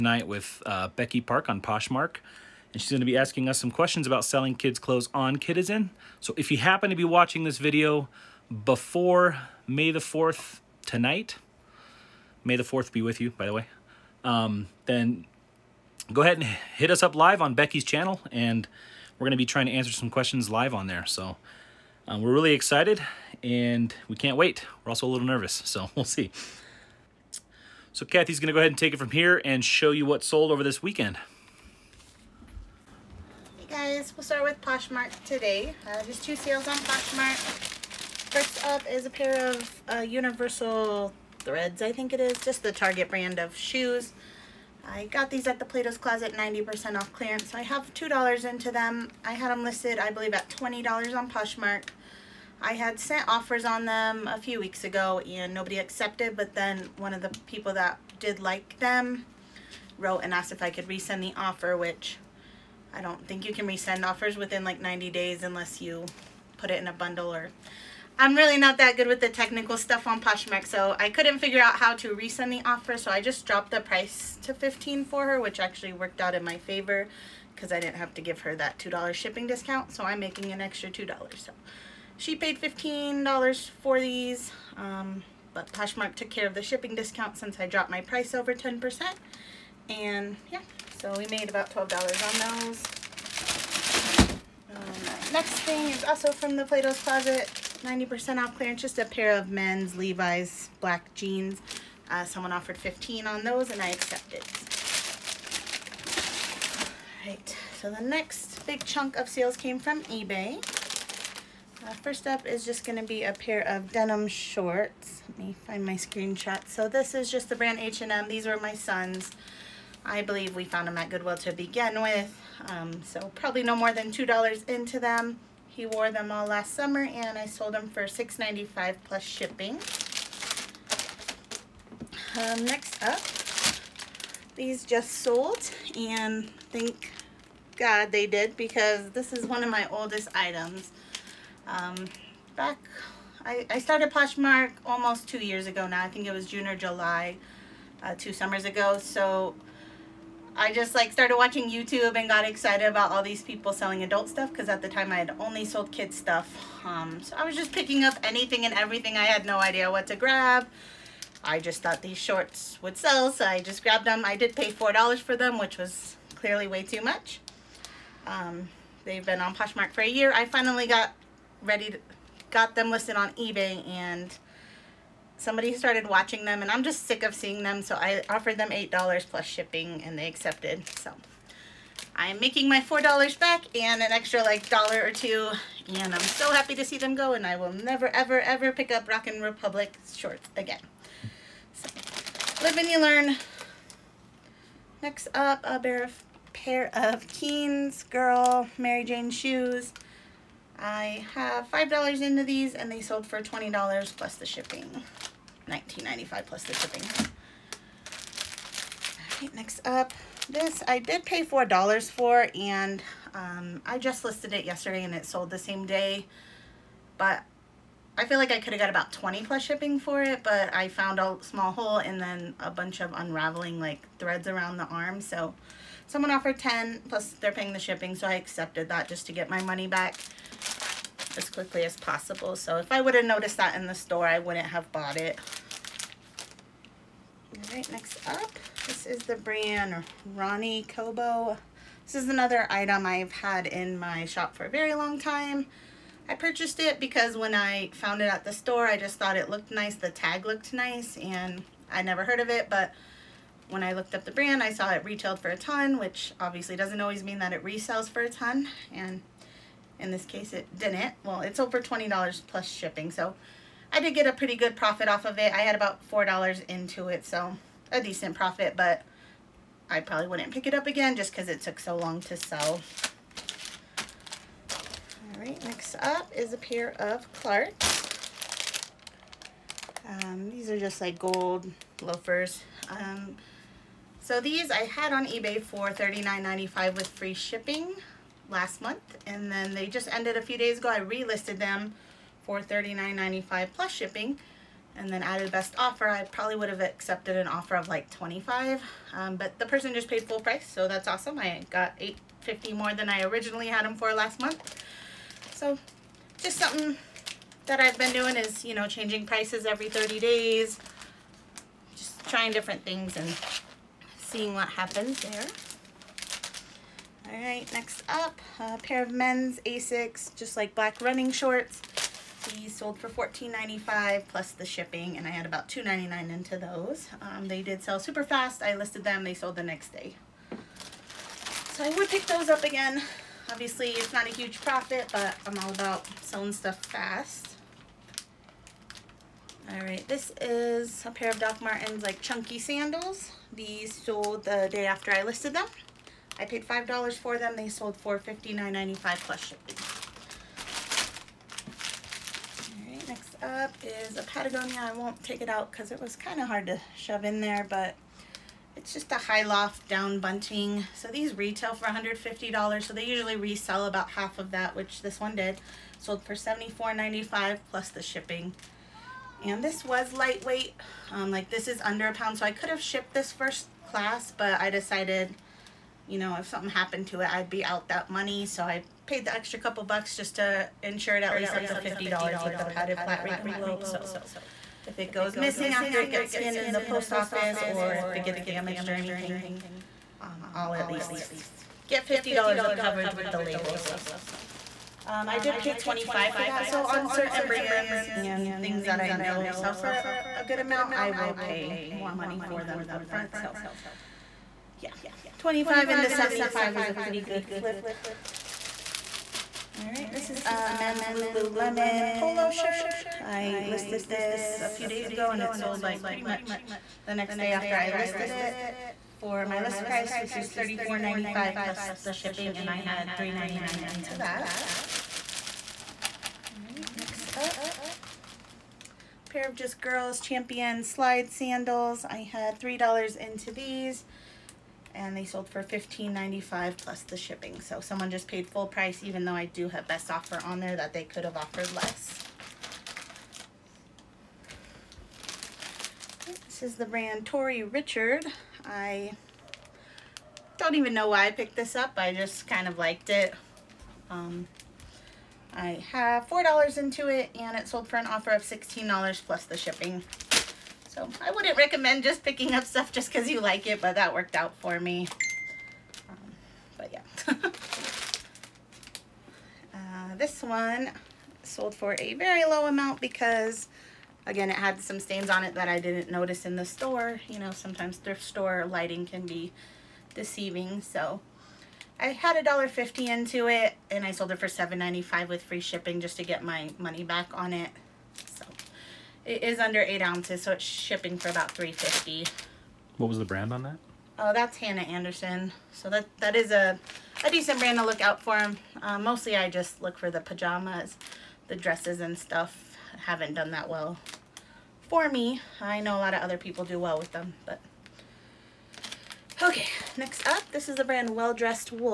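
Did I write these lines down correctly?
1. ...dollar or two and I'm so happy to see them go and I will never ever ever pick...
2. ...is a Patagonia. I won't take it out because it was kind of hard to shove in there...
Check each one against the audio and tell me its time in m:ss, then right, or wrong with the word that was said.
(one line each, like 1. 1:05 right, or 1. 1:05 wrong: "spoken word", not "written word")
1. 3:04 right
2. 5:53 right.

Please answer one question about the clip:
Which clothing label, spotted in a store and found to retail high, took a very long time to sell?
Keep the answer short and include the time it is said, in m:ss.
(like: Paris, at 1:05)
Ronny Kobo, at 4:00.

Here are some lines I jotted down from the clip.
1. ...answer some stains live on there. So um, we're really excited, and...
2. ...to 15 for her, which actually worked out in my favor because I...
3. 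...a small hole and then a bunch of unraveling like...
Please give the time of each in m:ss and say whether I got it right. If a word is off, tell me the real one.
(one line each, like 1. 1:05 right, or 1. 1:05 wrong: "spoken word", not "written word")
1. 0:19 wrong: "questions", not "stains"
2. 1:14 right
3. 3:41 right.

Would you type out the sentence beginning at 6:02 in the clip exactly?
So they usually resell about half of that, which this one did.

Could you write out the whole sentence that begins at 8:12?
What was the brand on that?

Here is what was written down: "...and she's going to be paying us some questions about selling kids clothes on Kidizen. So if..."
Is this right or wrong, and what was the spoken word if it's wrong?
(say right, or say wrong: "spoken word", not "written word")
wrong: "asking", not "paying".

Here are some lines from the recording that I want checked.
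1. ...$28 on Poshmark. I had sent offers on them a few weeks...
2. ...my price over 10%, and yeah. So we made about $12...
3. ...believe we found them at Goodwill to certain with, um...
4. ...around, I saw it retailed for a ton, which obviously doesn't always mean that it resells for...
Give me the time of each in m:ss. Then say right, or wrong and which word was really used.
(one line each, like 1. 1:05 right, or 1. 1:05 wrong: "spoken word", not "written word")
1. 0:50 wrong: "20", not "28"
2. 1:27 right
3. 2:00 wrong: "begin", not "certain"
4. 4:14 wrong: "brand", not "around".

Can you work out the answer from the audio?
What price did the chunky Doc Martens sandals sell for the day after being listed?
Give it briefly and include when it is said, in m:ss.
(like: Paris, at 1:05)
$59.95, at 5:48.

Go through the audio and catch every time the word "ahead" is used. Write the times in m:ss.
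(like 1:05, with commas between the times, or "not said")
0:16, 0:28.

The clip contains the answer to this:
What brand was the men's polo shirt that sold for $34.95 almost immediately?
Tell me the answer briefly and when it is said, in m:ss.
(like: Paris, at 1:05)
Lululemon, at 6:51.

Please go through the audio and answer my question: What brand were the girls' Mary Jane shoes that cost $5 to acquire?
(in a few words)
Keens.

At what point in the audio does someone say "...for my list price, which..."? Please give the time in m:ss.
6:59.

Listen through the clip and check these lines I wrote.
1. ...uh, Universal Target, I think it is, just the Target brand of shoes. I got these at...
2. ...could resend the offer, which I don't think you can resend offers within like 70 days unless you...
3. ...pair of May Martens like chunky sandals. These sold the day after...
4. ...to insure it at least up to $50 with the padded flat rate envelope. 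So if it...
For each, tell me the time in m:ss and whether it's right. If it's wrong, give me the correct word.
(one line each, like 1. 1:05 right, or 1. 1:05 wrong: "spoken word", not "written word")
1. 0:39 wrong: "Threads", not "Target"
2. 1:00 wrong: "90", not "70"
3. 5:41 wrong: "Doc", not "May"
4. 6:20 right.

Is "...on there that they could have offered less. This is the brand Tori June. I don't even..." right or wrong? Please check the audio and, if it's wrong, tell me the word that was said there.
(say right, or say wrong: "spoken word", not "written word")
wrong: "Richard", not "June".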